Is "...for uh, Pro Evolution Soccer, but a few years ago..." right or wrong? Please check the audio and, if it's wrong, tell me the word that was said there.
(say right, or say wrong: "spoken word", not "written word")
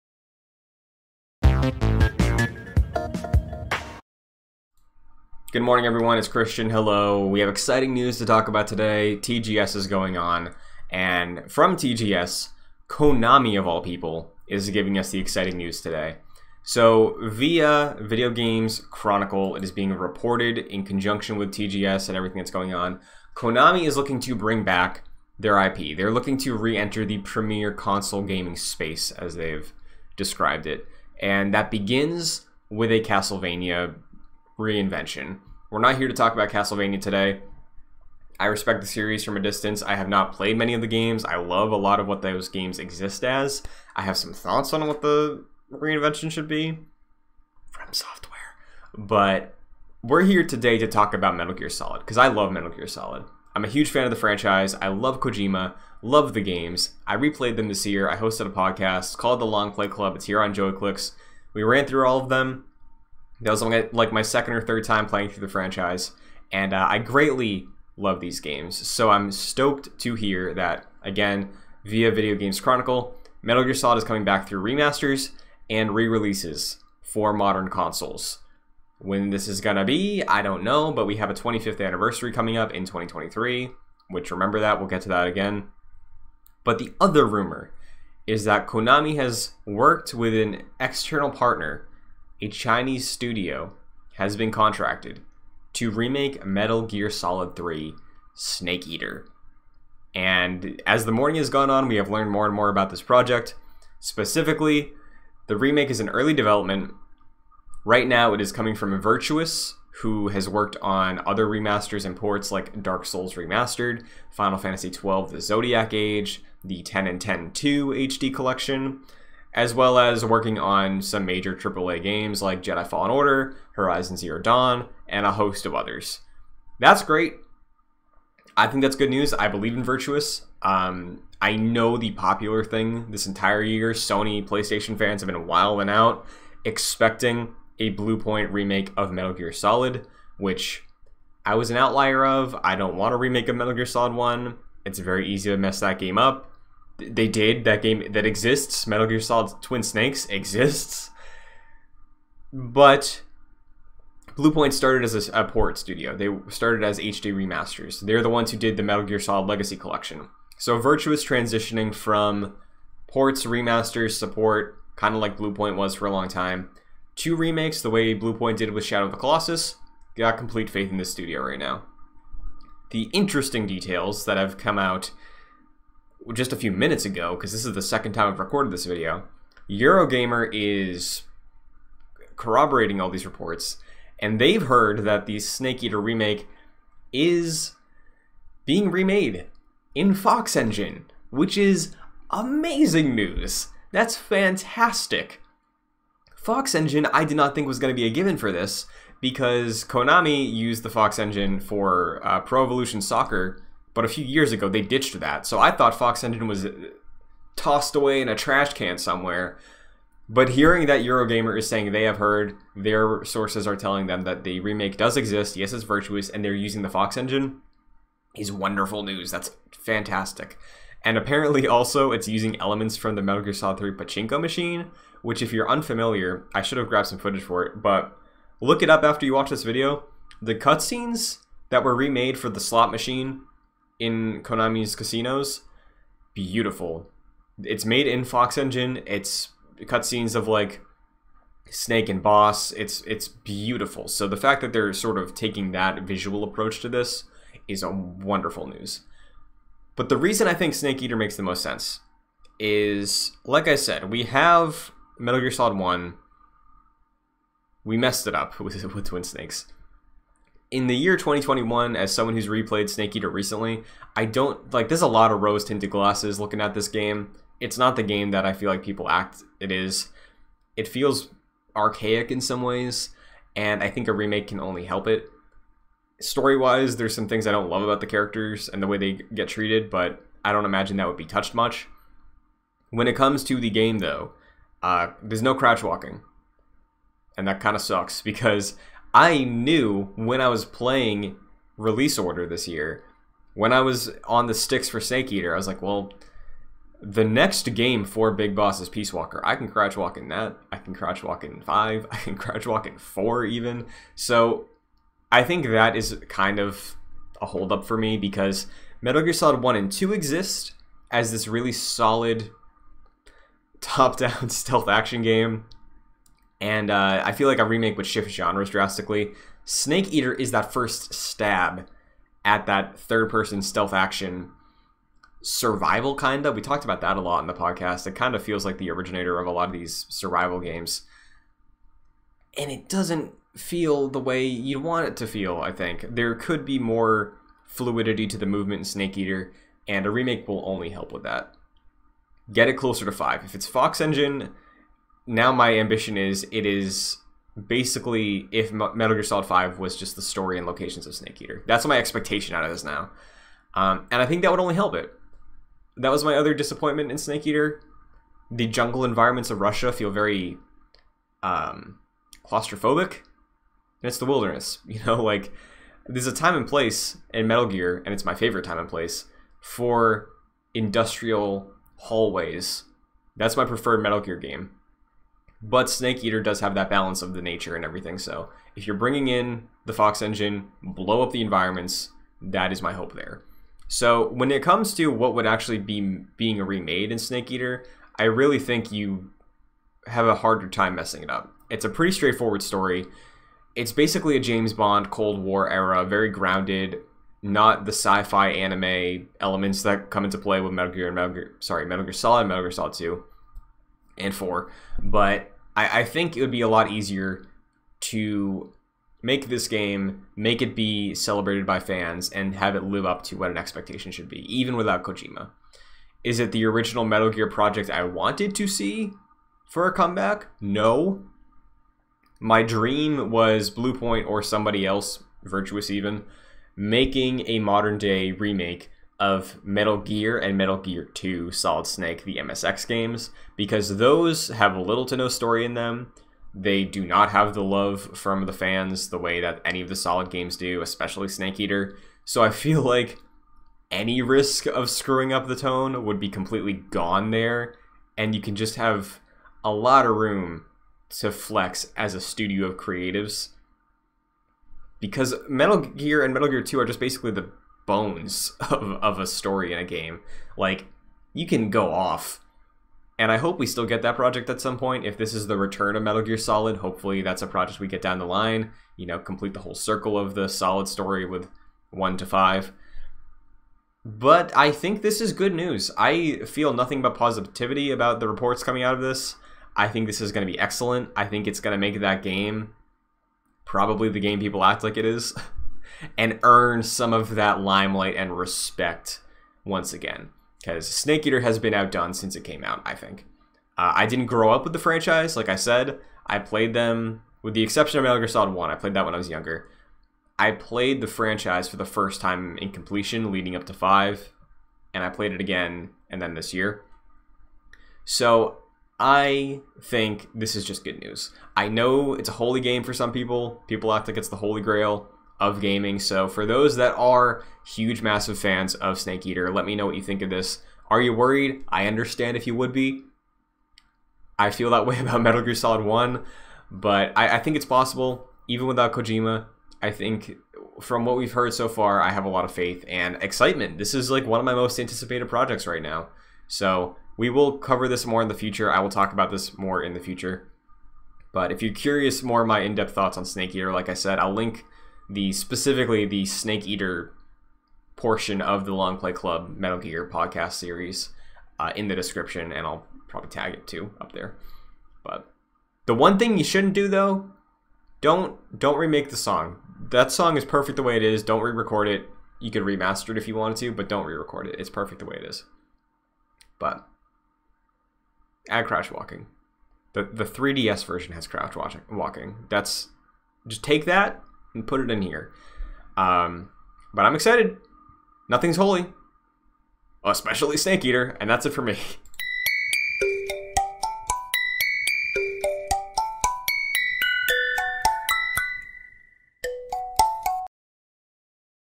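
right.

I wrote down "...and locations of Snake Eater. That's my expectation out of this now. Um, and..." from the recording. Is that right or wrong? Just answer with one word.
right.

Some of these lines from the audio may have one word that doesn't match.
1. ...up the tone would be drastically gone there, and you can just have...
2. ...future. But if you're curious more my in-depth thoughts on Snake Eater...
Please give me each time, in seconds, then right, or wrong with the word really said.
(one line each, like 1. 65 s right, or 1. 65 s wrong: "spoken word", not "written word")
1. 445 s wrong: "completely", not "drastically"
2. 539 s right.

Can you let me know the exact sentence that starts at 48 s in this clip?
But we're here today to talk about Metal Gear Solid because I love Metal Gear Solid.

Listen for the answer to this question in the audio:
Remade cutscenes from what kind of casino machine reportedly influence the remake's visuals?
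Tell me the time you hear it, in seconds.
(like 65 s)
223 s.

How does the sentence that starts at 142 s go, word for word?
I don't want to remake a Metal Gear Solid 1.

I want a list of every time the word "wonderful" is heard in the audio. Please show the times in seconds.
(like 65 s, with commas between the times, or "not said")
218 s, 247 s.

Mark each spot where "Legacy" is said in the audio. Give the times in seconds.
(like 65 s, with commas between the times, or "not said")
159 s.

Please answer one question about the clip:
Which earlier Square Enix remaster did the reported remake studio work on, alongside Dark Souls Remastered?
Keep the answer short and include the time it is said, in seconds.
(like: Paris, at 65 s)
Final Fantasy XII The Zodiac Age, at 114 s.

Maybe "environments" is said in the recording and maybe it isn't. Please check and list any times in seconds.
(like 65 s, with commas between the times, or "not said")
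359 s, 381 s.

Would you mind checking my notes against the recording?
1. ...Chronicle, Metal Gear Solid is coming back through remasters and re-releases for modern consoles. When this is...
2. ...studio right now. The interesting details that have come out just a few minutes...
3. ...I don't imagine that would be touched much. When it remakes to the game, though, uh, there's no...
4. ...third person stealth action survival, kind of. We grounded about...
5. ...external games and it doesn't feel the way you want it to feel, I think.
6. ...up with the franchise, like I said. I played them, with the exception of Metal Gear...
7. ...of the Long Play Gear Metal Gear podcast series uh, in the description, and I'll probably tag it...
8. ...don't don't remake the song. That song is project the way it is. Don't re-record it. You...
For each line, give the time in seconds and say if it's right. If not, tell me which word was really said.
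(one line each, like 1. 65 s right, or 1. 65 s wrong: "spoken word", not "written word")
1. 72 s right
2. 171 s right
3. 280 s wrong: "comes", not "remakes"
4. 322 s wrong: "talked", not "grounded"
5. 330 s wrong: "survival", not "external"
6. 494 s right
7. 548 s wrong: "Club", not "Gear"
8. 558 s wrong: "perfect", not "project".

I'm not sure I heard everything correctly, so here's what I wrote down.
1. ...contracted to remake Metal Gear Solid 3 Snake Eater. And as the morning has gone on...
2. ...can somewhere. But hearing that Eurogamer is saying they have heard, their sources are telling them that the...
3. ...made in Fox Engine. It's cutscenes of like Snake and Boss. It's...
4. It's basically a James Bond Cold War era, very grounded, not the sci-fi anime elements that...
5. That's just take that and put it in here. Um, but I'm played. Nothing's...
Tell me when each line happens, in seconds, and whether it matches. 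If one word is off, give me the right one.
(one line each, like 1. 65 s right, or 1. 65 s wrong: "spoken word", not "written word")
1. 94 s right
2. 208 s right
3. 237 s right
4. 393 s right
5. 572 s wrong: "excited", not "played".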